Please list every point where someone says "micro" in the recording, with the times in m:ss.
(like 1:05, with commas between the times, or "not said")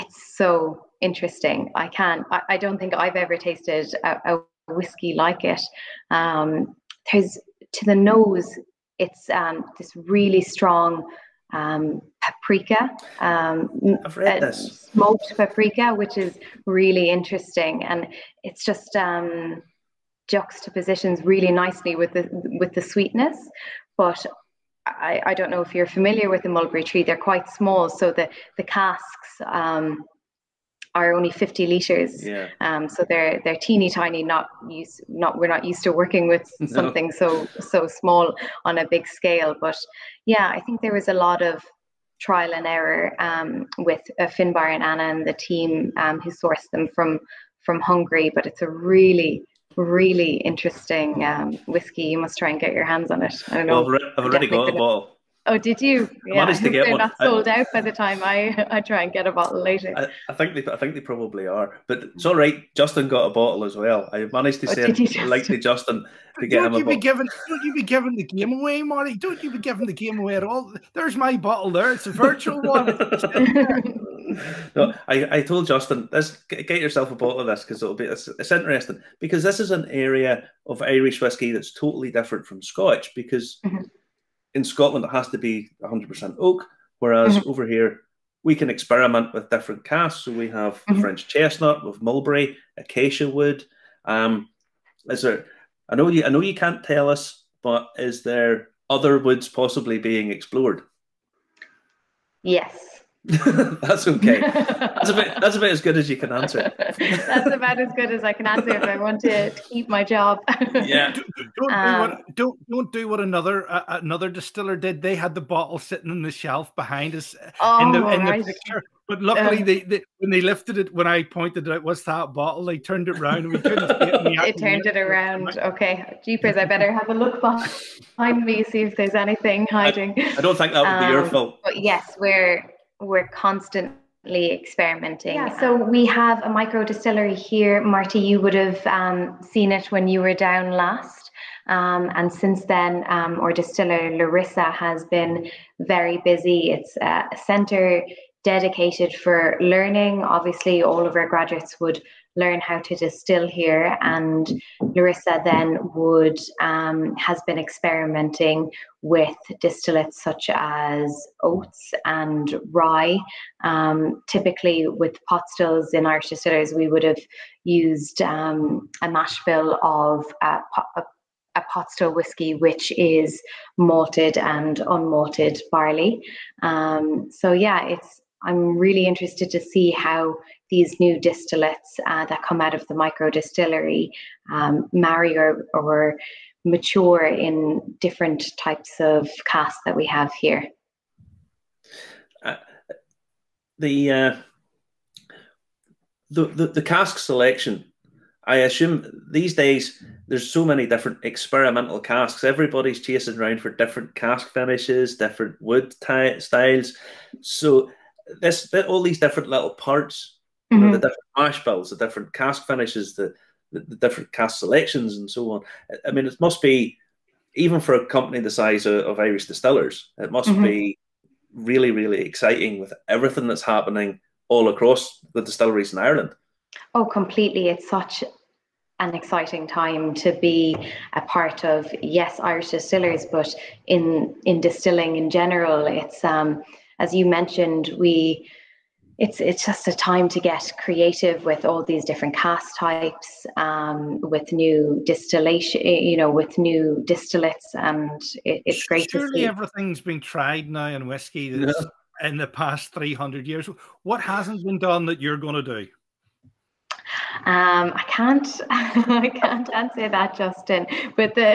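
2:16, 3:02.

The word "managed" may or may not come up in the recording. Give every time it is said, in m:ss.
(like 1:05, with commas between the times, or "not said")
0:56, 1:04.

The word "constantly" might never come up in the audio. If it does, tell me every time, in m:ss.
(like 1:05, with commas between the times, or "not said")
2:13.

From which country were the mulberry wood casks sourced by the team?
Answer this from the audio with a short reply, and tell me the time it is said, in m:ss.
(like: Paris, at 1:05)
Hungary, at 0:47.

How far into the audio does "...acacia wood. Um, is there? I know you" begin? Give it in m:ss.
1:32.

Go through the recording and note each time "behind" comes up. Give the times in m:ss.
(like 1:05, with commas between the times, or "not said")
1:56, 2:07.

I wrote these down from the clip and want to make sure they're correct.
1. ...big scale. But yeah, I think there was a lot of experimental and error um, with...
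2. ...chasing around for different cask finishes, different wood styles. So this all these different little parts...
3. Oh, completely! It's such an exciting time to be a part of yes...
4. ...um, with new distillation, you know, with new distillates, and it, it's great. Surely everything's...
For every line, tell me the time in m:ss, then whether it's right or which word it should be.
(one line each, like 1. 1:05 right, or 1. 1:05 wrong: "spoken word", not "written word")
1. 0:38 wrong: "trial", not "experimental"
2. 3:22 right
3. 3:46 right
4. 4:03 right.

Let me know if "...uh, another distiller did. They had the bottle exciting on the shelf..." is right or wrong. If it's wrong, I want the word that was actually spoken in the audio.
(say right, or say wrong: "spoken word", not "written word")
wrong: "sitting", not "exciting".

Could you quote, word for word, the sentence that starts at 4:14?
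What hasn't been done that you're going to do?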